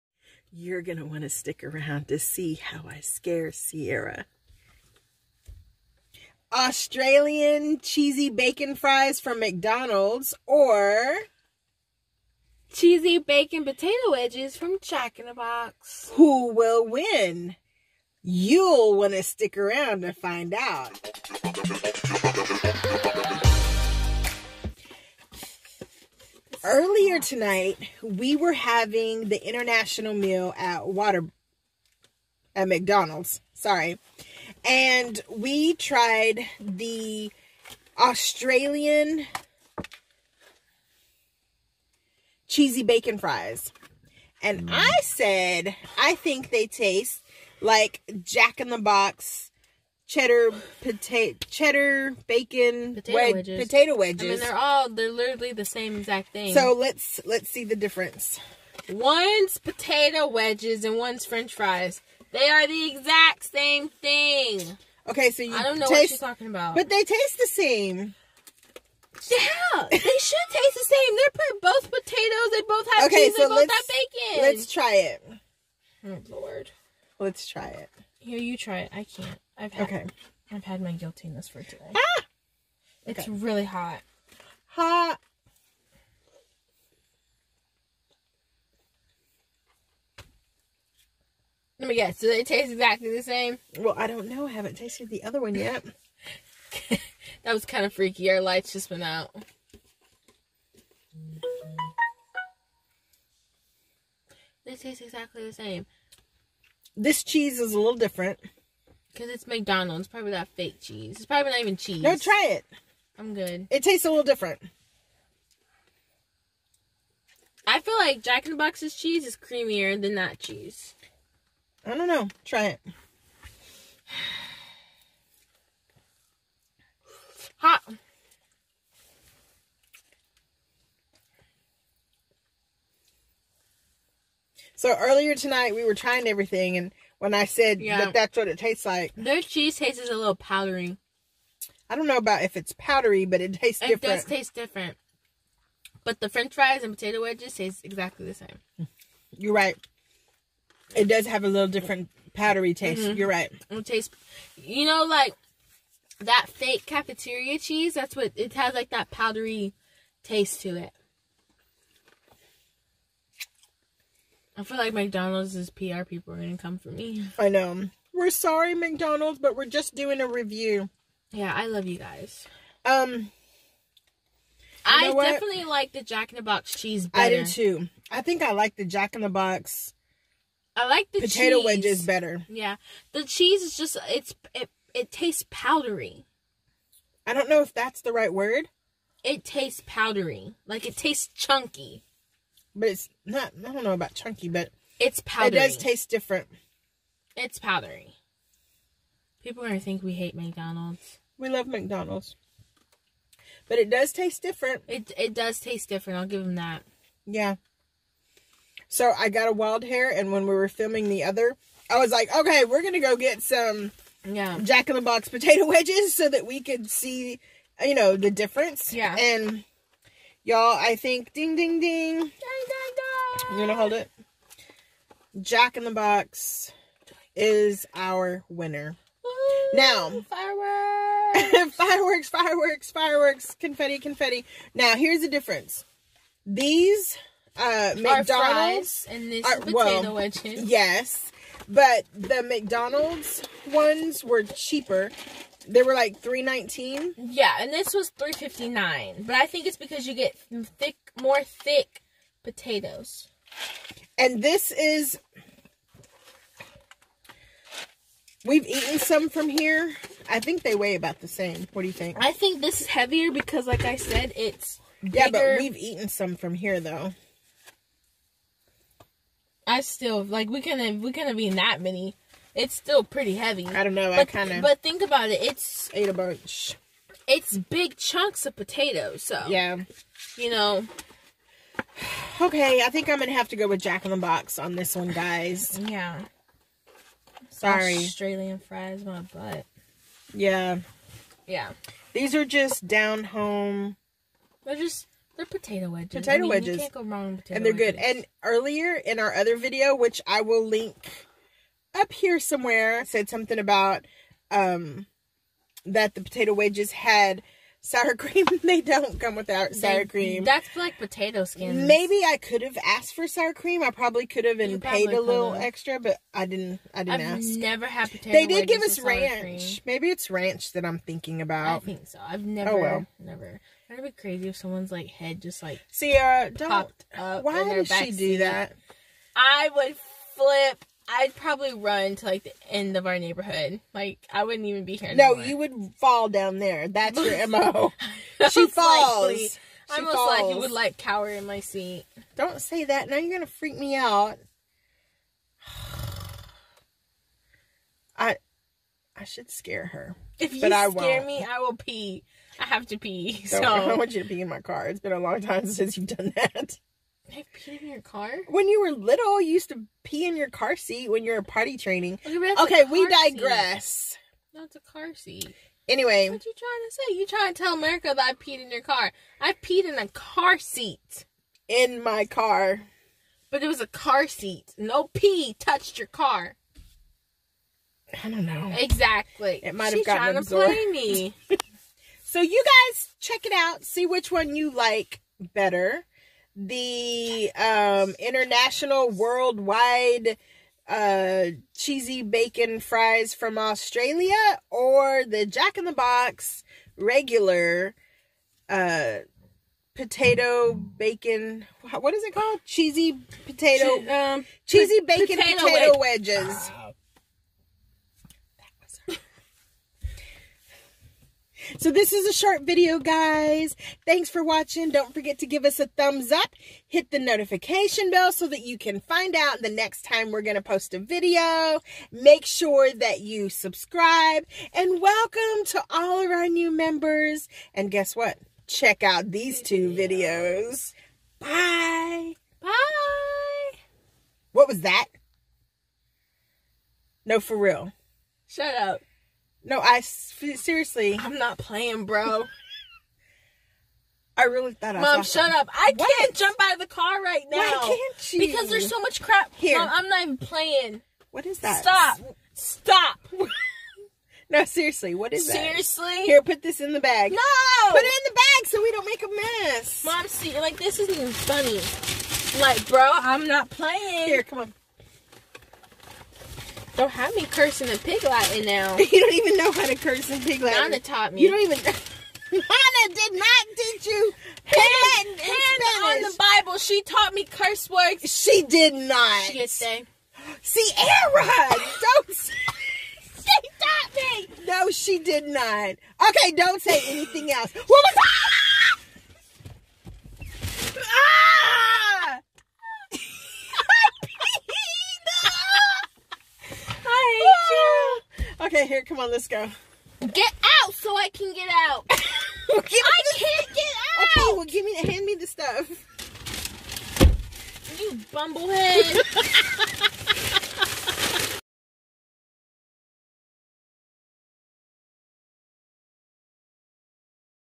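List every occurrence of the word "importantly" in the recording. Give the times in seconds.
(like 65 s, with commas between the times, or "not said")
not said.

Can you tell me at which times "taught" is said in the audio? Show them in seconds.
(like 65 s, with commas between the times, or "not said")
470 s, 477 s, 483 s.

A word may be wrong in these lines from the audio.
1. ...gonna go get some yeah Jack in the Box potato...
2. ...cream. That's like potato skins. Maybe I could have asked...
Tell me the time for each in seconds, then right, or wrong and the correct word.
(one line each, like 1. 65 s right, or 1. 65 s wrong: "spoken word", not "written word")
1. 212 s right
2. 310 s right.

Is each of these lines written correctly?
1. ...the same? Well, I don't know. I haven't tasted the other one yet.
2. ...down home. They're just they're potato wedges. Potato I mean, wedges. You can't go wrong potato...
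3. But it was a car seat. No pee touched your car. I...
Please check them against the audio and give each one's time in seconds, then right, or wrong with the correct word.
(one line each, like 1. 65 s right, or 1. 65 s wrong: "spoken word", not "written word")
1. 93 s right
2. 292 s right
3. 373 s right.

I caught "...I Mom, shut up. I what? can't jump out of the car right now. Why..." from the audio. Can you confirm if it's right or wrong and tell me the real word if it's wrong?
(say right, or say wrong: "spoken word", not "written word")
right.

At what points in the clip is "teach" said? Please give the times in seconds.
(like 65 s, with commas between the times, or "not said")
473 s.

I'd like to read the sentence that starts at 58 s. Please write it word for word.
One's potato wedges and one's french fries.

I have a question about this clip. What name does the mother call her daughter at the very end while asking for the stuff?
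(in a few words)
Bumblehead.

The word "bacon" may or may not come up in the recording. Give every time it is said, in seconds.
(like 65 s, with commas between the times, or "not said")
8 s, 13 s, 42 s, 52 s, 73 s, 392 s, 400 s, 405 s.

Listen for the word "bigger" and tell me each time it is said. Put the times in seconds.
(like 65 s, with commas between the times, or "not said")
265 s.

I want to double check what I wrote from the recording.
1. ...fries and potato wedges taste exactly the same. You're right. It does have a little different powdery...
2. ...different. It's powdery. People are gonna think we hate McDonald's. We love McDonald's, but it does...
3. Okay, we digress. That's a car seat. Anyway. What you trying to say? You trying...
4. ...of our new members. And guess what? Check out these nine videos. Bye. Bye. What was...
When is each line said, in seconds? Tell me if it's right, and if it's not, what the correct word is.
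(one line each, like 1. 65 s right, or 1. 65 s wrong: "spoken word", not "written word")
1. 146 s right
2. 196 s right
3. 362 s right
4. 426 s wrong: "two", not "nine".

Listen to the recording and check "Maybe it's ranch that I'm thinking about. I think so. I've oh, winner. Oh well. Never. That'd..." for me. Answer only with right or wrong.
wrong.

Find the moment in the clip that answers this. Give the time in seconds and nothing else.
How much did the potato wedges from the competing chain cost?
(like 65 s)
248 s.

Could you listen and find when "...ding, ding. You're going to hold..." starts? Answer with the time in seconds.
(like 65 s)
222 s.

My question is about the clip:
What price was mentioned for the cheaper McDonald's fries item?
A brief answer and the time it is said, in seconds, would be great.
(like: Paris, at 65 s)
3.19, at 246 s.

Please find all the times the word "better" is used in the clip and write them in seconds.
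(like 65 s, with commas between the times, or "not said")
177 s, 182 s, 385 s.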